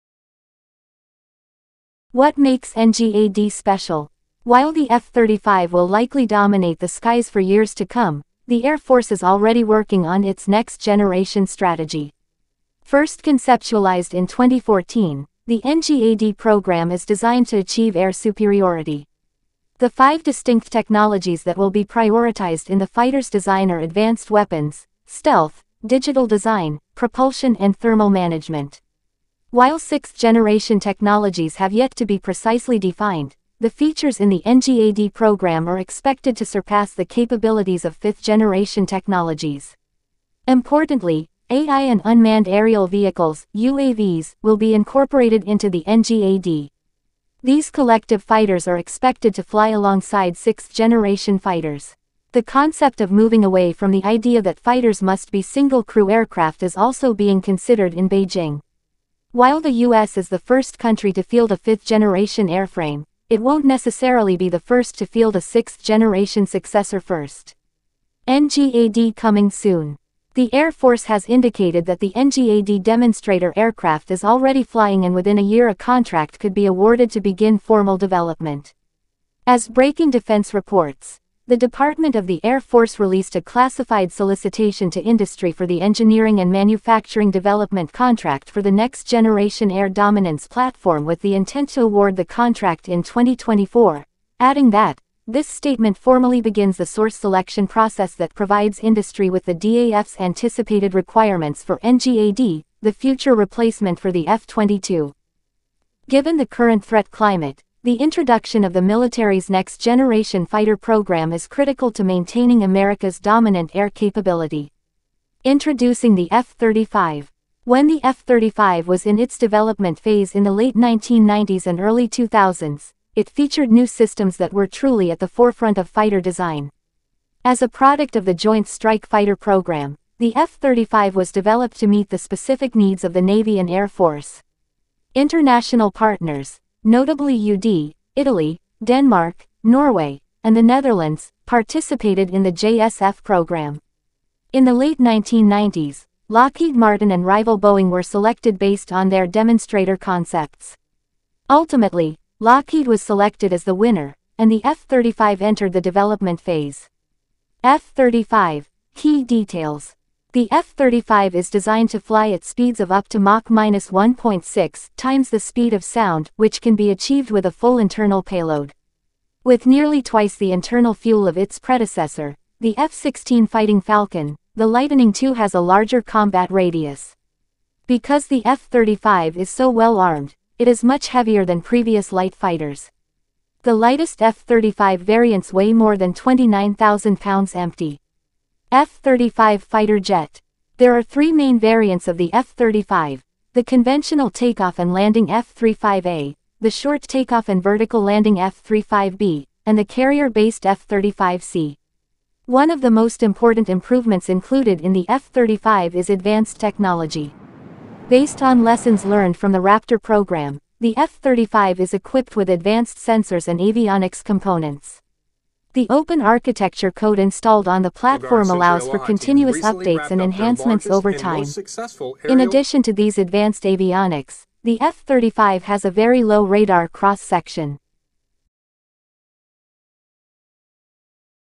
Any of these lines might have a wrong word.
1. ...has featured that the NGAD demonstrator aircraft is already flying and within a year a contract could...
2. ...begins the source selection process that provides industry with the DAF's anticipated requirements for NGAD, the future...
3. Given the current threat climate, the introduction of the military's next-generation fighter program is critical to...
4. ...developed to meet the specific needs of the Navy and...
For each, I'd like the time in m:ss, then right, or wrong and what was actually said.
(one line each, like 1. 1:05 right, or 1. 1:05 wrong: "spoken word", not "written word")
1. 1:11 wrong: "indicated", not "featured"
2. 1:36 right
3. 1:46 right
4. 2:11 right.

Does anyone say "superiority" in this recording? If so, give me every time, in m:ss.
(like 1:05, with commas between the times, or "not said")
0:18.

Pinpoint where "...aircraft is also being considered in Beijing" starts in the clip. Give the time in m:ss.
0:56.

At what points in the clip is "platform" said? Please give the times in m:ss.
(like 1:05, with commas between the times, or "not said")
1:30, 3:37.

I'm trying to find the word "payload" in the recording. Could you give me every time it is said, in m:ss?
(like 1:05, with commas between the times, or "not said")
2:48.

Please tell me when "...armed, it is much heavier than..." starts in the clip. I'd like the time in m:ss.
2:59.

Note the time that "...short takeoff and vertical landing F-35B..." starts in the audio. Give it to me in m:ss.
3:16.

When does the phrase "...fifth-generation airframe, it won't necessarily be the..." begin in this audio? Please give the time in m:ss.
1:01.